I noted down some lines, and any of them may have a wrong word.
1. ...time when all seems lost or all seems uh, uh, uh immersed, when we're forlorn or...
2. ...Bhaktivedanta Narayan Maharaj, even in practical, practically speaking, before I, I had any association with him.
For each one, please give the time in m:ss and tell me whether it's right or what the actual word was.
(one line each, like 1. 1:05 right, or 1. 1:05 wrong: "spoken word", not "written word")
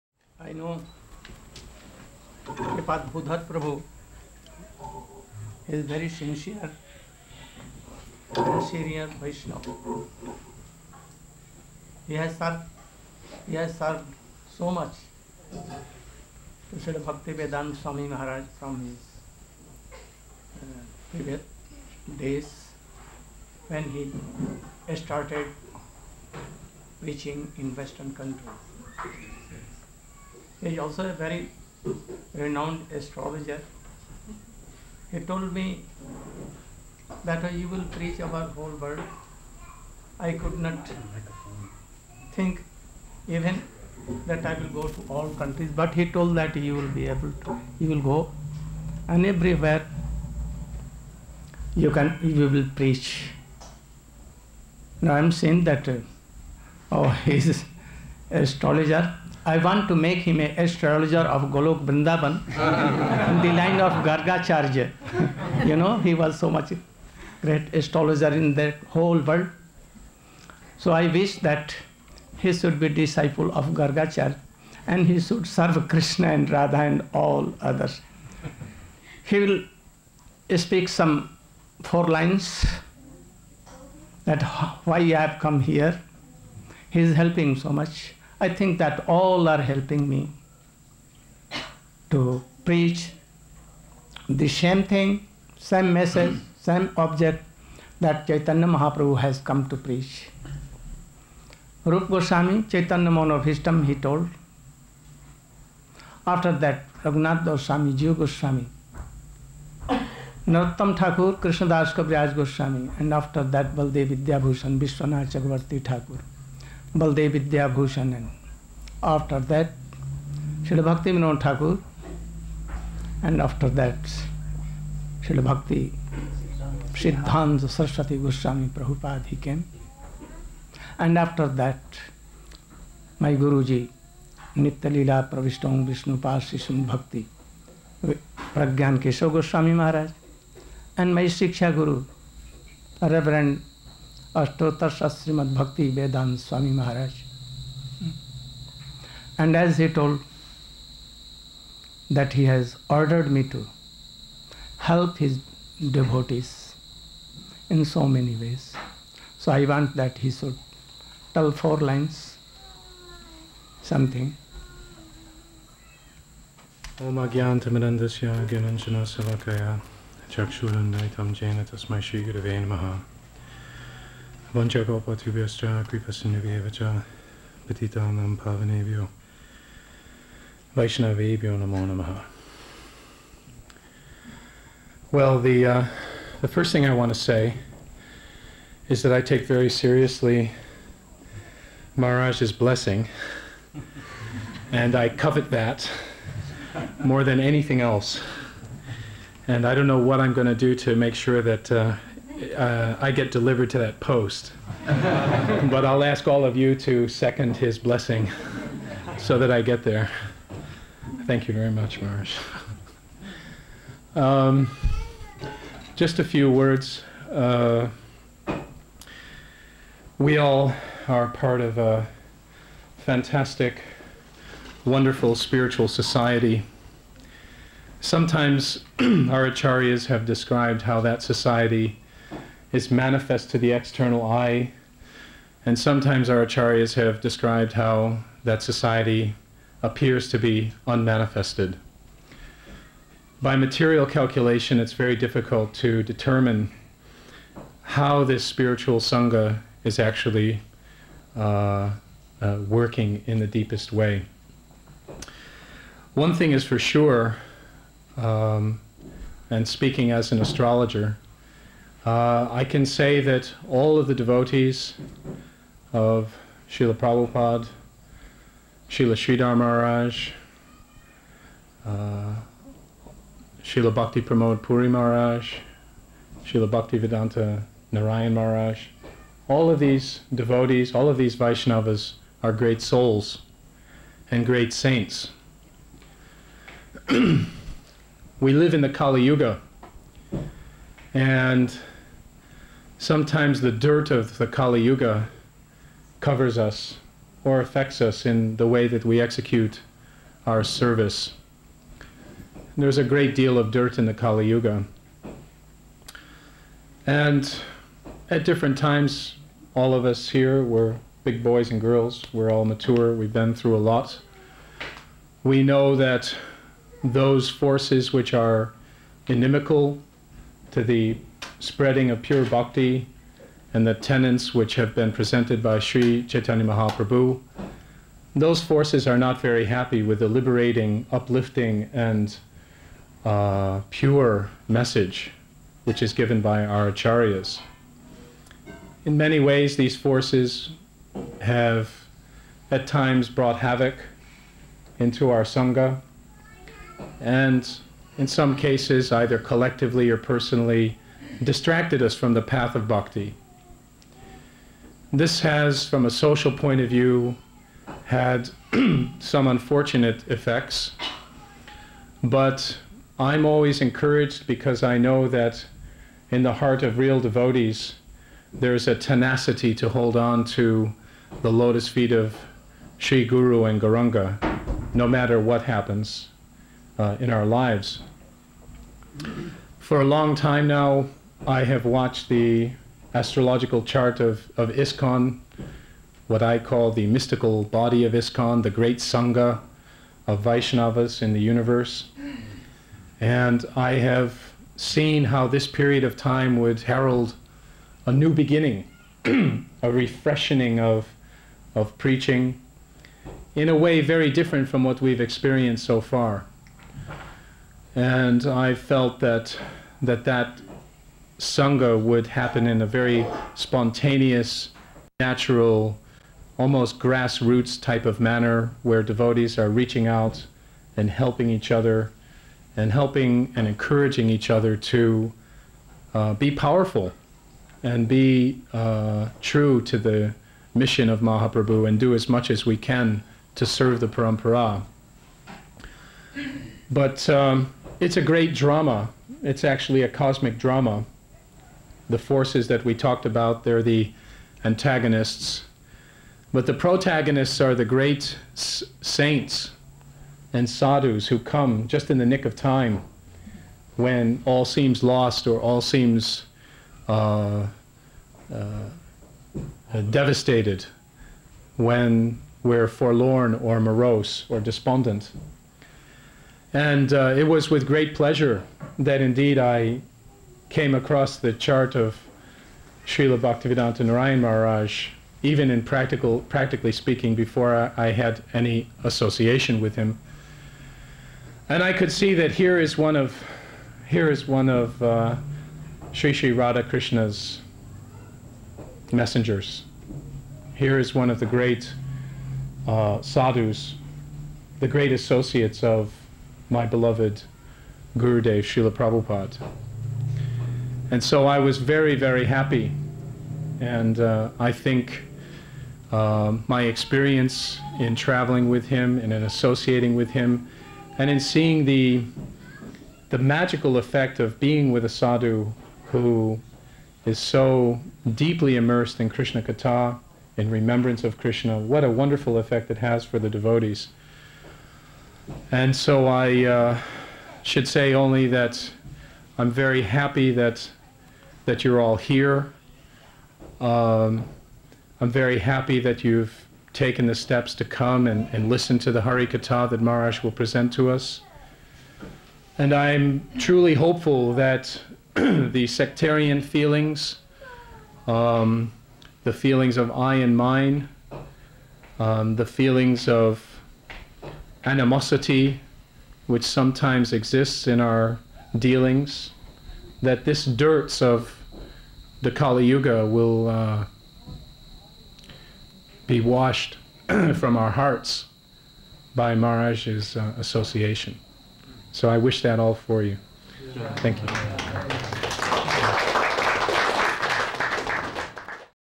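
1. 7:32 wrong: "devastated", not "immersed"
2. 7:53 right.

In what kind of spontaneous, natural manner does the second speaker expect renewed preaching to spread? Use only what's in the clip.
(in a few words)
Grassroots.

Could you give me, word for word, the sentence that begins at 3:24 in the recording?
but I'll ask all of you to second his blessing so that I get there.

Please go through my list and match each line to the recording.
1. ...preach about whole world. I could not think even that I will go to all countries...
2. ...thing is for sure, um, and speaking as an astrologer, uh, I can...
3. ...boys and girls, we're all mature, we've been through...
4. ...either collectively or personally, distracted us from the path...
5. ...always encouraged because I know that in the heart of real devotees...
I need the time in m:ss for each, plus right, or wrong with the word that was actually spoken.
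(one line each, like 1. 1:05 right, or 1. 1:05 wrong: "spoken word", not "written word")
1. 0:37 right
2. 4:16 right
3. 5:11 right
4. 5:49 right
5. 6:03 right.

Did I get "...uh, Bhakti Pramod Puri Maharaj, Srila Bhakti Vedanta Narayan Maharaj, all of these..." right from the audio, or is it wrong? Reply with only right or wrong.
right.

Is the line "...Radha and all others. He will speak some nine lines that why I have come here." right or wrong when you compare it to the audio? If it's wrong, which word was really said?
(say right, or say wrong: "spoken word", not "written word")
wrong: "four", not "nine".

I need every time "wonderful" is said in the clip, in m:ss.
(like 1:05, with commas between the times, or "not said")
3:44, 8:42.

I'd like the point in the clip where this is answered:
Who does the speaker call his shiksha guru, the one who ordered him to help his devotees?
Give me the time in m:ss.
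2:25.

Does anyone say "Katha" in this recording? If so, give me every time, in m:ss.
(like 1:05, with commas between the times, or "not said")
8:39, 8:59.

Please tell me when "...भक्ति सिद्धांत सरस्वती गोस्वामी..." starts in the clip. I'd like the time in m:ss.
2:05.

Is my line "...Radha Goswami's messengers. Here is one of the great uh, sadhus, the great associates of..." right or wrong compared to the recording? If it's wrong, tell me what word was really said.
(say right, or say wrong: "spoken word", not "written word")
wrong: "Krishna", not "Goswami".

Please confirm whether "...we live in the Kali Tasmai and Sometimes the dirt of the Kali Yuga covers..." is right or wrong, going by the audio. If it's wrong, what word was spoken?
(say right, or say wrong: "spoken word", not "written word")
wrong: "Yuga", not "Tasmai".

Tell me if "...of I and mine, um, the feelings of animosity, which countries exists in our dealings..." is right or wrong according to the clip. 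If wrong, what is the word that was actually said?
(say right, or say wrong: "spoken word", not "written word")
wrong: "sometimes", not "countries".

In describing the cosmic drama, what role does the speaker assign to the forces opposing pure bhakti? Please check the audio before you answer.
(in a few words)
Antagonists.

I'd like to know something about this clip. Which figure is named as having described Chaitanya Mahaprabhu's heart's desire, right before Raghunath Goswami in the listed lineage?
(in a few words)
Rup Goswami.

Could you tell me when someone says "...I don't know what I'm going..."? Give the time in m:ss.
3:19.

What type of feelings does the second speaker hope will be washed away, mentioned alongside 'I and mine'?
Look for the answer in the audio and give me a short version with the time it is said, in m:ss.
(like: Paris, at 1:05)
Sectarian feelings, at 9:05.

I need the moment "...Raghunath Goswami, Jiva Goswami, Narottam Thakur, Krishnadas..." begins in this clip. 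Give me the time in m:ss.
1:47.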